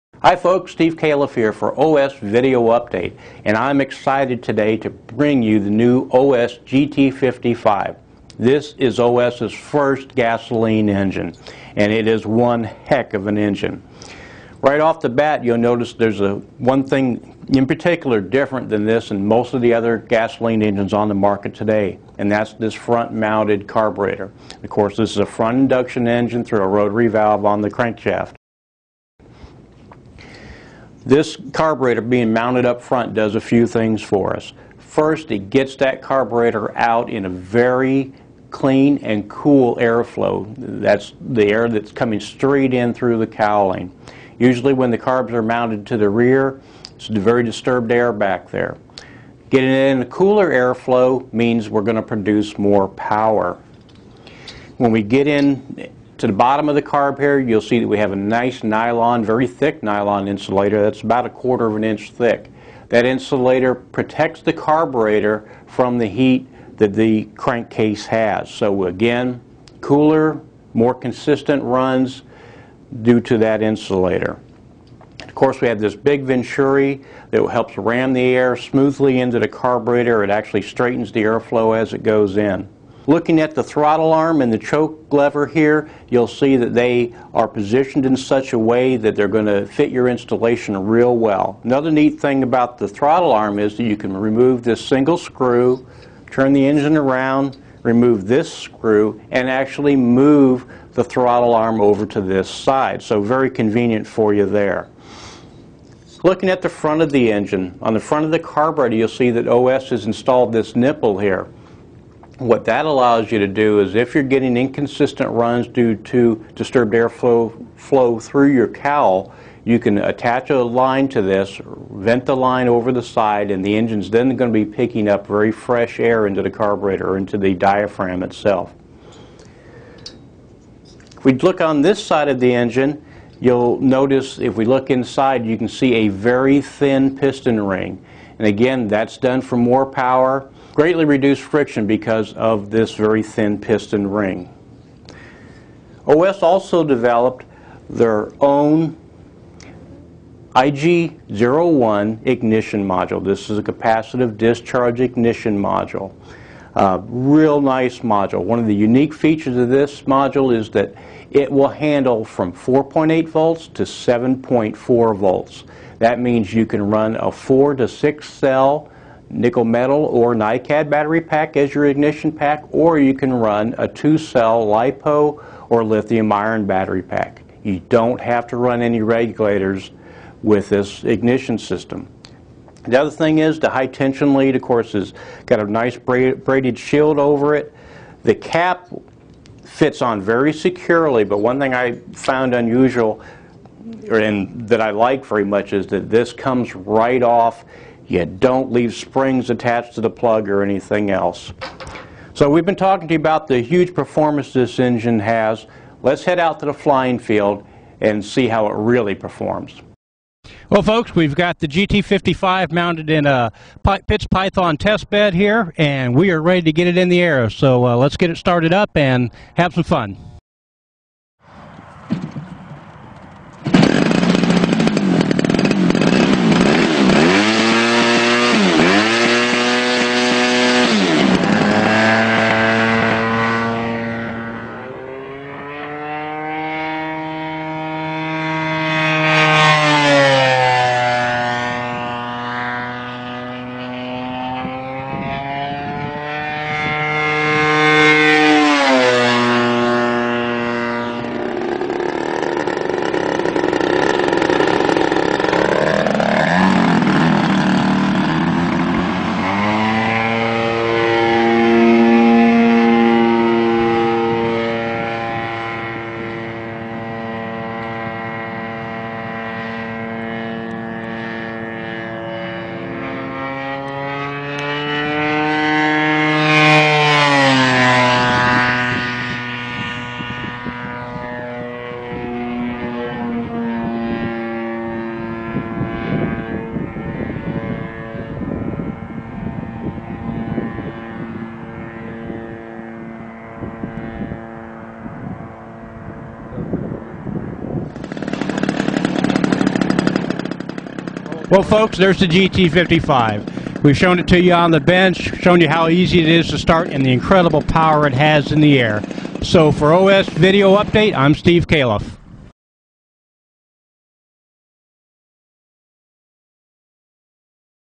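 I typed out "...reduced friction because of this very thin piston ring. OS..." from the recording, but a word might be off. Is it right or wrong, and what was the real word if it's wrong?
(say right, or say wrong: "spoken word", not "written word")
right.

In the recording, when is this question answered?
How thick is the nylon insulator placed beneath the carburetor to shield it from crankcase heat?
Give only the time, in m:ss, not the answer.
1:01.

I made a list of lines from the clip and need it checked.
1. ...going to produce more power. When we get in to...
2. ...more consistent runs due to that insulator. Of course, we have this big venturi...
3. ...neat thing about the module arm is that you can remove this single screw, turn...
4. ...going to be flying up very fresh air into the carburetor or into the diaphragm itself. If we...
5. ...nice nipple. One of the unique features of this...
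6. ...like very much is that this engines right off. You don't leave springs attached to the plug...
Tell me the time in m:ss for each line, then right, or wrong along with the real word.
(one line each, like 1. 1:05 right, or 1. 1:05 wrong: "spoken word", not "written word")
1. 0:51 right
2. 1:10 right
3. 1:31 wrong: "throttle", not "module"
4. 2:04 wrong: "picking", not "flying"
5. 2:37 wrong: "module", not "nipple"
6. 3:14 wrong: "comes", not "engines".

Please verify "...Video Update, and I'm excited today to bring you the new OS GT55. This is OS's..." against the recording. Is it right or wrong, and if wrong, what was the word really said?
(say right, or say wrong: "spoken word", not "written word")
right.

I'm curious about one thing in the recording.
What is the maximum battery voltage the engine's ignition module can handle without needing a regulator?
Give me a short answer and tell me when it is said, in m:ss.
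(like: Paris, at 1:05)
7.4 volts, at 2:43.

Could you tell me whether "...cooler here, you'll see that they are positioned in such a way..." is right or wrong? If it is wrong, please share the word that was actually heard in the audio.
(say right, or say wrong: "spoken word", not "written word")
wrong: "lever", not "cooler".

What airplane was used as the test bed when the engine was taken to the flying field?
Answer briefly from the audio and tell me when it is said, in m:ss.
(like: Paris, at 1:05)
Pitts Python, at 3:34.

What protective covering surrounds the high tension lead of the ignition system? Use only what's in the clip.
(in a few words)
braided shield.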